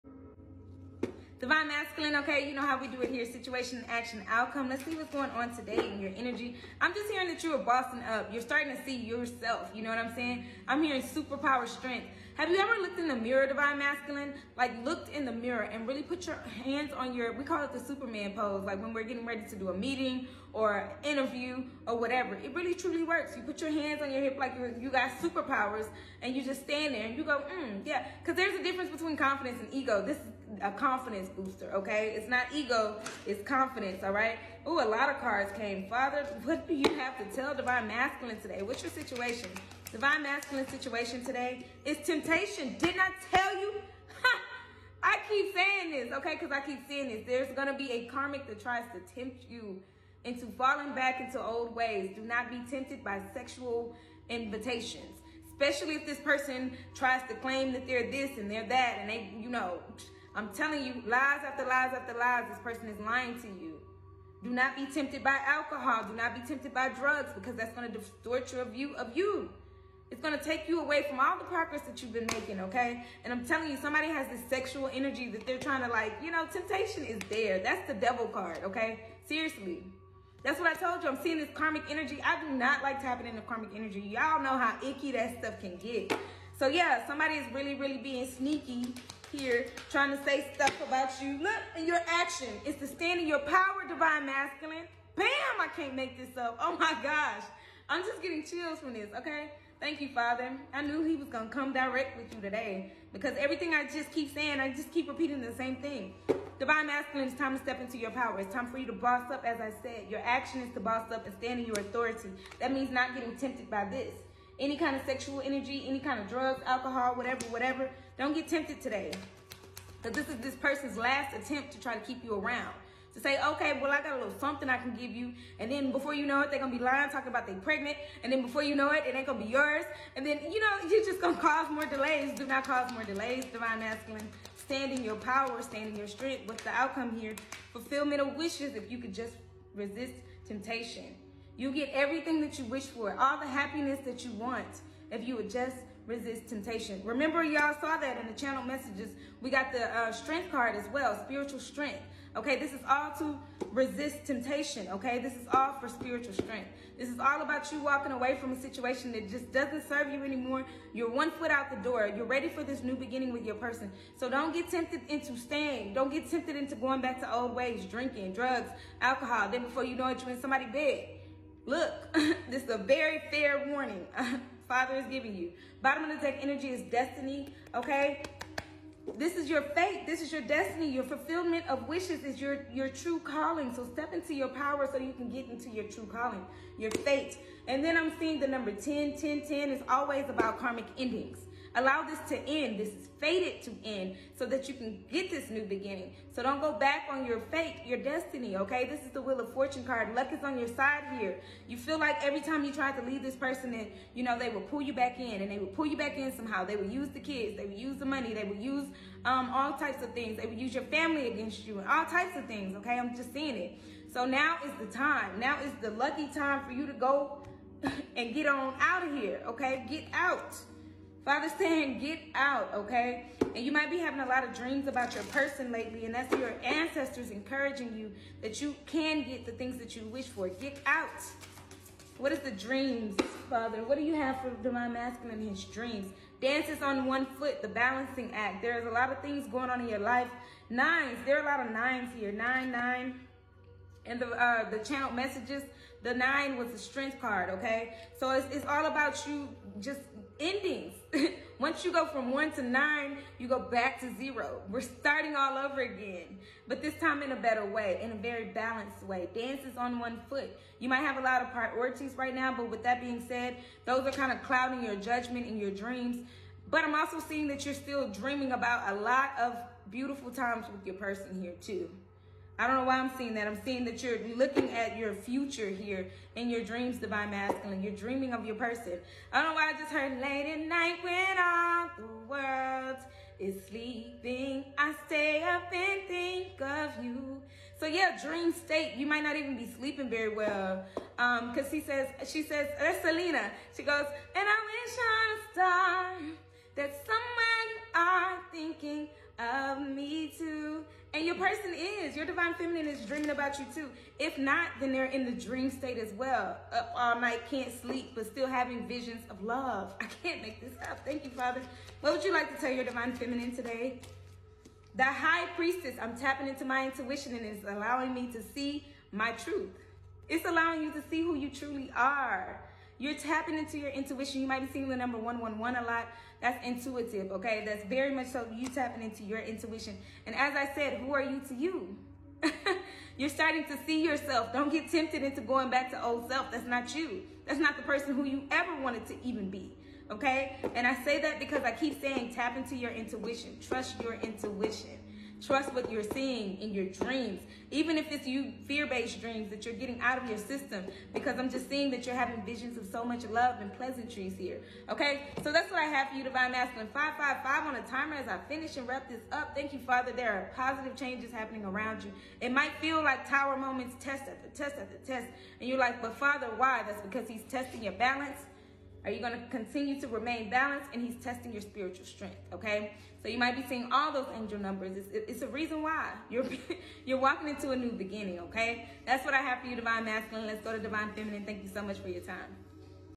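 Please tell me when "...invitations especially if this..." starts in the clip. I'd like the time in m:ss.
0:54.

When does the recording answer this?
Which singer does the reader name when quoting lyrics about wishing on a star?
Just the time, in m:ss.
4:53.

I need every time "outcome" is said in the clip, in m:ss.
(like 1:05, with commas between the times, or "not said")
0:04, 2:16.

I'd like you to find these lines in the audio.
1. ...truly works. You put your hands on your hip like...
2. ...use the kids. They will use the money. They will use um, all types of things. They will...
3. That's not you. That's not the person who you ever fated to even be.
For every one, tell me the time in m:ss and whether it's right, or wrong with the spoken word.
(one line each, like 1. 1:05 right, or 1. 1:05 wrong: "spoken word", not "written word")
1. 0:22 right
2. 3:26 right
3. 5:36 wrong: "wanted", not "fated".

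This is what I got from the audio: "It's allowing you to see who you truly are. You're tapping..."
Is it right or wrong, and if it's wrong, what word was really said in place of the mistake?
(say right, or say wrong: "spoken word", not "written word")
right.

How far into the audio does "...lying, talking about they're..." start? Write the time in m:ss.
2:06.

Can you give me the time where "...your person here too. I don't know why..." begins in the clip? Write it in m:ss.
4:30.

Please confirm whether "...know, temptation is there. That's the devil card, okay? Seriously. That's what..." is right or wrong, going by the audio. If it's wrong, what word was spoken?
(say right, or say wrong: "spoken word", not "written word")
right.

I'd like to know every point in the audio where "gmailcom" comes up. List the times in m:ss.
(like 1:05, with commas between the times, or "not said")
not said.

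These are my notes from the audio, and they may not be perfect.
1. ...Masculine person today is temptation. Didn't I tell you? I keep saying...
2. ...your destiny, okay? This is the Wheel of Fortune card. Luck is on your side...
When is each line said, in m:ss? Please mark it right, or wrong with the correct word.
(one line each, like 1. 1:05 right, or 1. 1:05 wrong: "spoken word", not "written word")
1. 0:40 wrong: "situation", not "person"
2. 3:17 right.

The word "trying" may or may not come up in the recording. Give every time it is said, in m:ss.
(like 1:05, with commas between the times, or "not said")
1:15, 1:29.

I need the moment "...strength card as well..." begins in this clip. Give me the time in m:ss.
2:30.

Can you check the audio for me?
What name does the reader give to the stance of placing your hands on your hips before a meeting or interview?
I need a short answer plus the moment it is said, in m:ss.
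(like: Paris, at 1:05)
Superman pose, at 0:17.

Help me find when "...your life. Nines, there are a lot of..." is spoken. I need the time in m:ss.
3:59.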